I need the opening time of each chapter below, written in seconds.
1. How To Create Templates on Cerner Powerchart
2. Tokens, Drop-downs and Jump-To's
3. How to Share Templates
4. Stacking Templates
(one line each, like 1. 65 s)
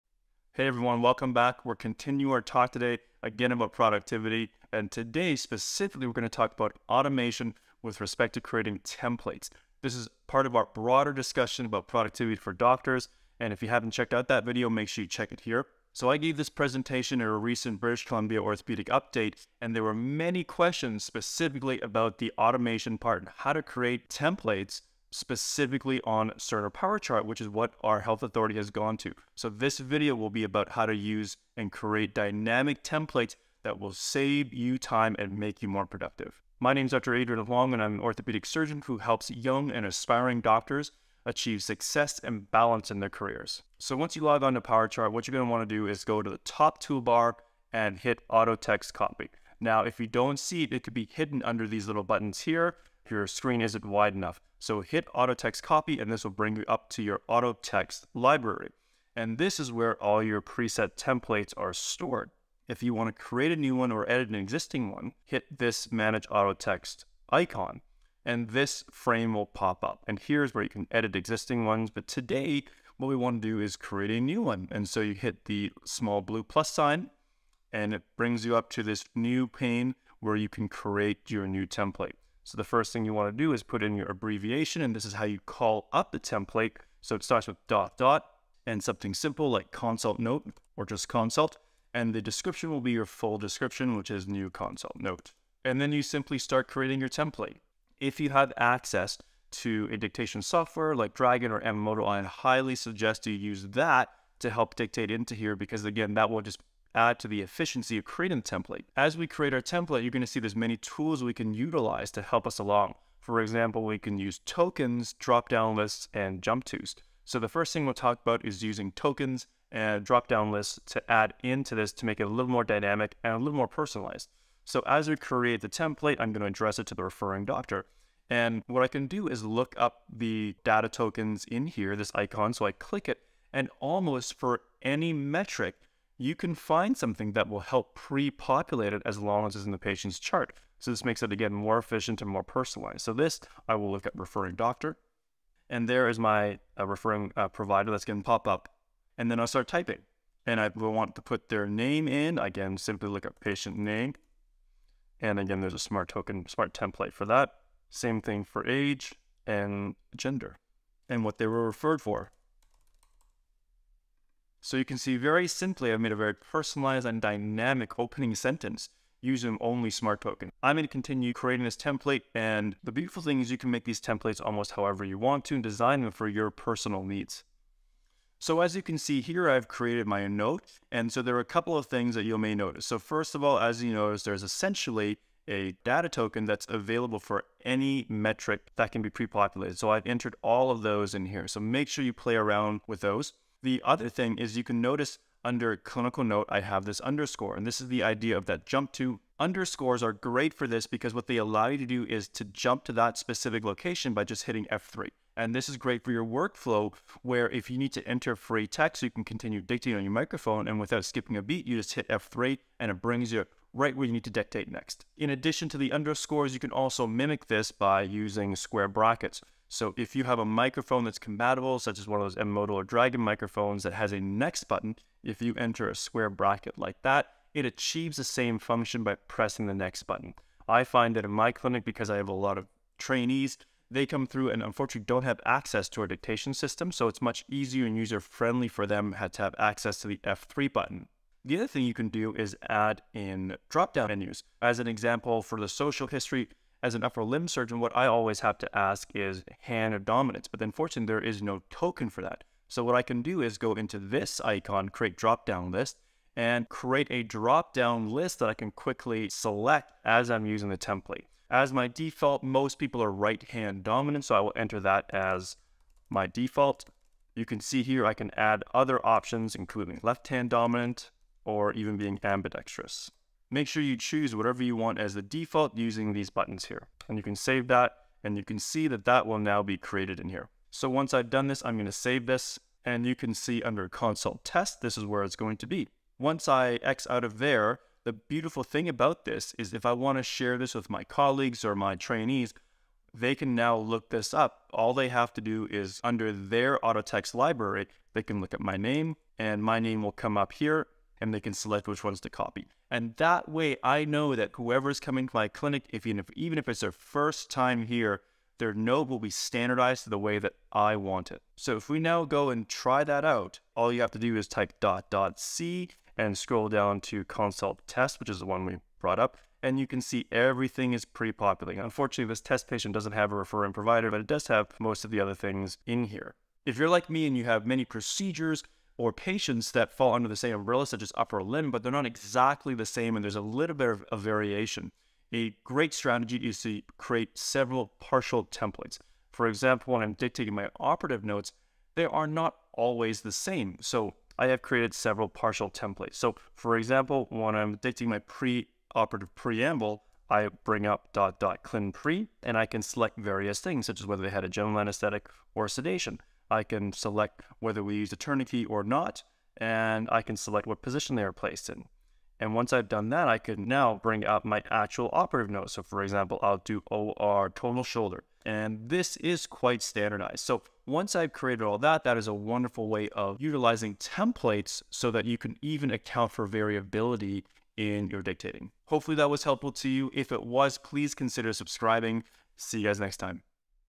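1. 43 s
2. 109 s
3. 286 s
4. 326 s.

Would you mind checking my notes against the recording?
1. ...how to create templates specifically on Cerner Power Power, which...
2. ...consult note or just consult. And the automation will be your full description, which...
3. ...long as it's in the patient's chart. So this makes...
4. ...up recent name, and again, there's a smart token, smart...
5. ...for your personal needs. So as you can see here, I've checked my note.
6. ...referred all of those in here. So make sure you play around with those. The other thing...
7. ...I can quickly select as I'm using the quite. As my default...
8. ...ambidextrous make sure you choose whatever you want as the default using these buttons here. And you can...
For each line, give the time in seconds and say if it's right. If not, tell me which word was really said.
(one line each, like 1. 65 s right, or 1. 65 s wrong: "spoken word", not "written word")
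1. 23 s wrong: "Chart", not "Power"
2. 89 s wrong: "description", not "automation"
3. 139 s right
4. 153 s wrong: "patient", not "recent"
5. 176 s wrong: "created", not "checked"
6. 190 s wrong: "entered", not "referred"
7. 258 s wrong: "template", not "quite"
8. 272 s right.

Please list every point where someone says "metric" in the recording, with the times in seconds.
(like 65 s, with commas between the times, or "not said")
135 s, 188 s.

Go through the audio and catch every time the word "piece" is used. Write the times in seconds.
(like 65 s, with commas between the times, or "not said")
not said.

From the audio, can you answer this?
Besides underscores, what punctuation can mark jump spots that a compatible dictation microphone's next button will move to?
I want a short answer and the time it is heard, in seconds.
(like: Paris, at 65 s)
square brackets, at 218 s.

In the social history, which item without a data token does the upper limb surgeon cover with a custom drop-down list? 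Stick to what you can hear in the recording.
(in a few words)
hand of dominance.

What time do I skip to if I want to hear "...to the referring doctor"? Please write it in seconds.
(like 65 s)
126 s.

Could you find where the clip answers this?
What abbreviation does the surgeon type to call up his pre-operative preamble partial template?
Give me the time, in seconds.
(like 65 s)
351 s.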